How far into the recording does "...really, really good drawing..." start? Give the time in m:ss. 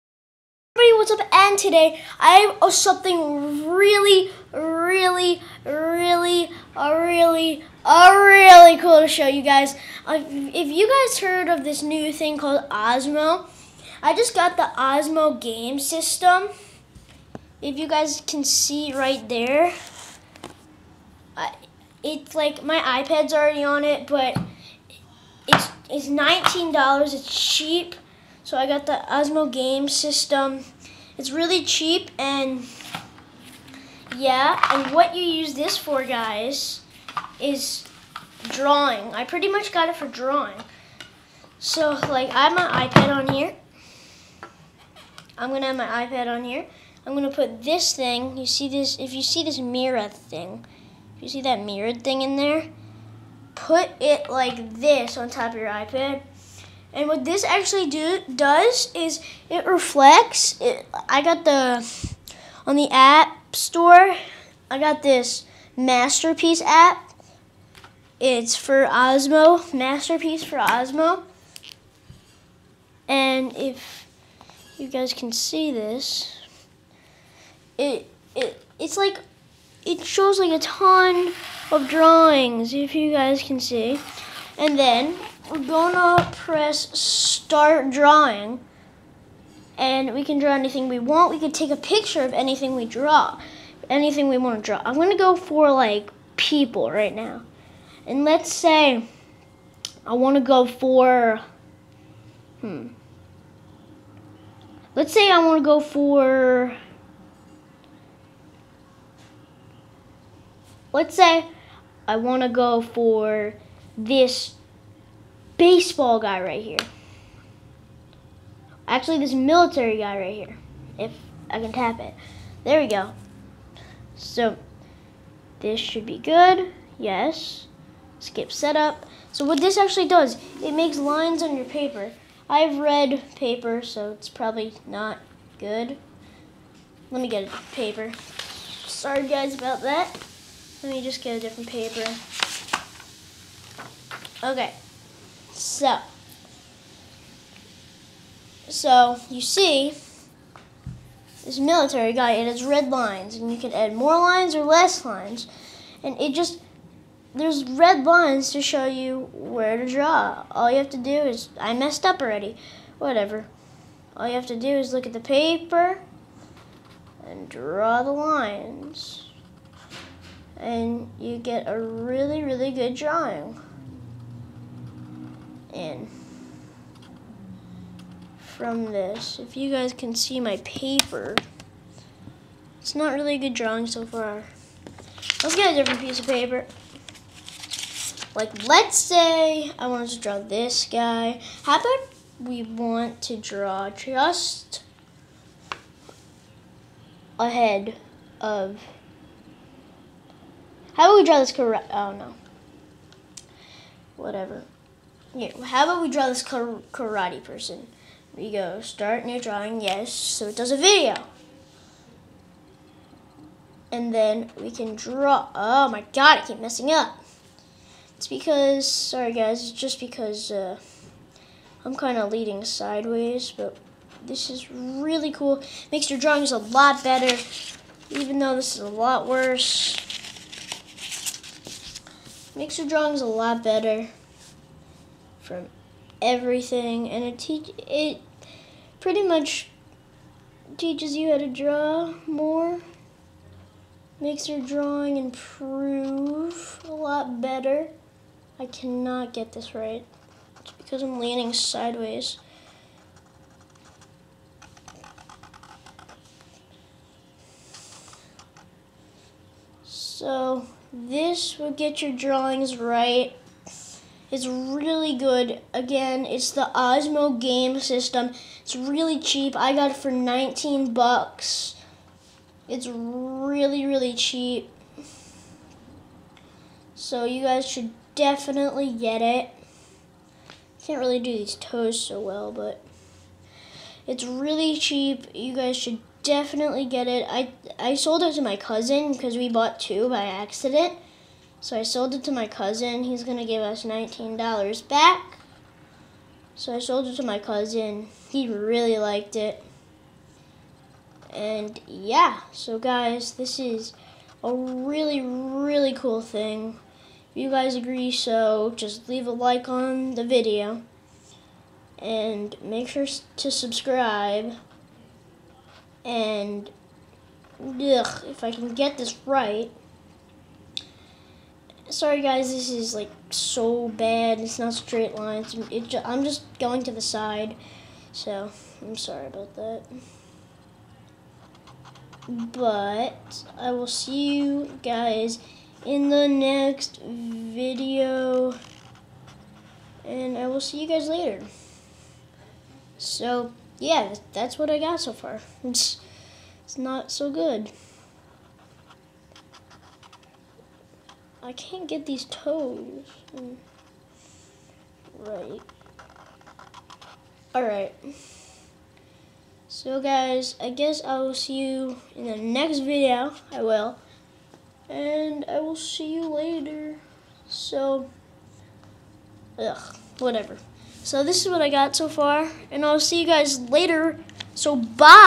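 2:51.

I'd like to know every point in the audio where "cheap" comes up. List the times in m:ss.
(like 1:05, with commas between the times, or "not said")
0:27, 0:31, 4:29, 4:34, 4:44.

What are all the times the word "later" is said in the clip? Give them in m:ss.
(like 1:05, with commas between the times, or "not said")
5:41, 6:06, 6:13.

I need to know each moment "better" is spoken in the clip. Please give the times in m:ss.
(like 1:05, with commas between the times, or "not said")
3:47, 3:53, 4:07.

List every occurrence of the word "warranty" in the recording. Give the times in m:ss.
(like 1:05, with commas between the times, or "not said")
not said.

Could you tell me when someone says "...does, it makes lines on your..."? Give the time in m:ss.
2:10.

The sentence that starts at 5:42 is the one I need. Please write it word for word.
So yeah, that's what I got so far.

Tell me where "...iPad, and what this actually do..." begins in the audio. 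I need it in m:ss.
0:55.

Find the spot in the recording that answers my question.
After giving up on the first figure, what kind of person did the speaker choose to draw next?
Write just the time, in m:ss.
3:26.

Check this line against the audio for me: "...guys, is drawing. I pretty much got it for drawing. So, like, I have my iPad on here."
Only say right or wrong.
right.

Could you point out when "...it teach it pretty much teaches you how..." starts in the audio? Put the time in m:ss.
3:57.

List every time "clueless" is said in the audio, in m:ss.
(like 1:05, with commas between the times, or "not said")
not said.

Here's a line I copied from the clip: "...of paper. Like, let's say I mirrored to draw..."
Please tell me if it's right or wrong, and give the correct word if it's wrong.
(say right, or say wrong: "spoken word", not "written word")
wrong: "wanted", not "mirrored".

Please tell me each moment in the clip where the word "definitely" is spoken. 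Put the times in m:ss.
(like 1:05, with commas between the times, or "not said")
4:38, 4:46.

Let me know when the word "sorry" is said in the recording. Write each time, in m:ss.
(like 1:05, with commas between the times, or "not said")
2:18, 3:38, 5:21, 5:28.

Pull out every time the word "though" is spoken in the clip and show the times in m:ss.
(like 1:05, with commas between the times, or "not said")
3:48.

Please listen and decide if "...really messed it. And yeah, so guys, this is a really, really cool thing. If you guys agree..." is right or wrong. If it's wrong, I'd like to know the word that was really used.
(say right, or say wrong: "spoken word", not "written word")
wrong: "liked", not "messed".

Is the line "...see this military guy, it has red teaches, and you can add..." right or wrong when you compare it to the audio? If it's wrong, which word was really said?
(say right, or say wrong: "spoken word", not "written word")
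wrong: "lines", not "teaches".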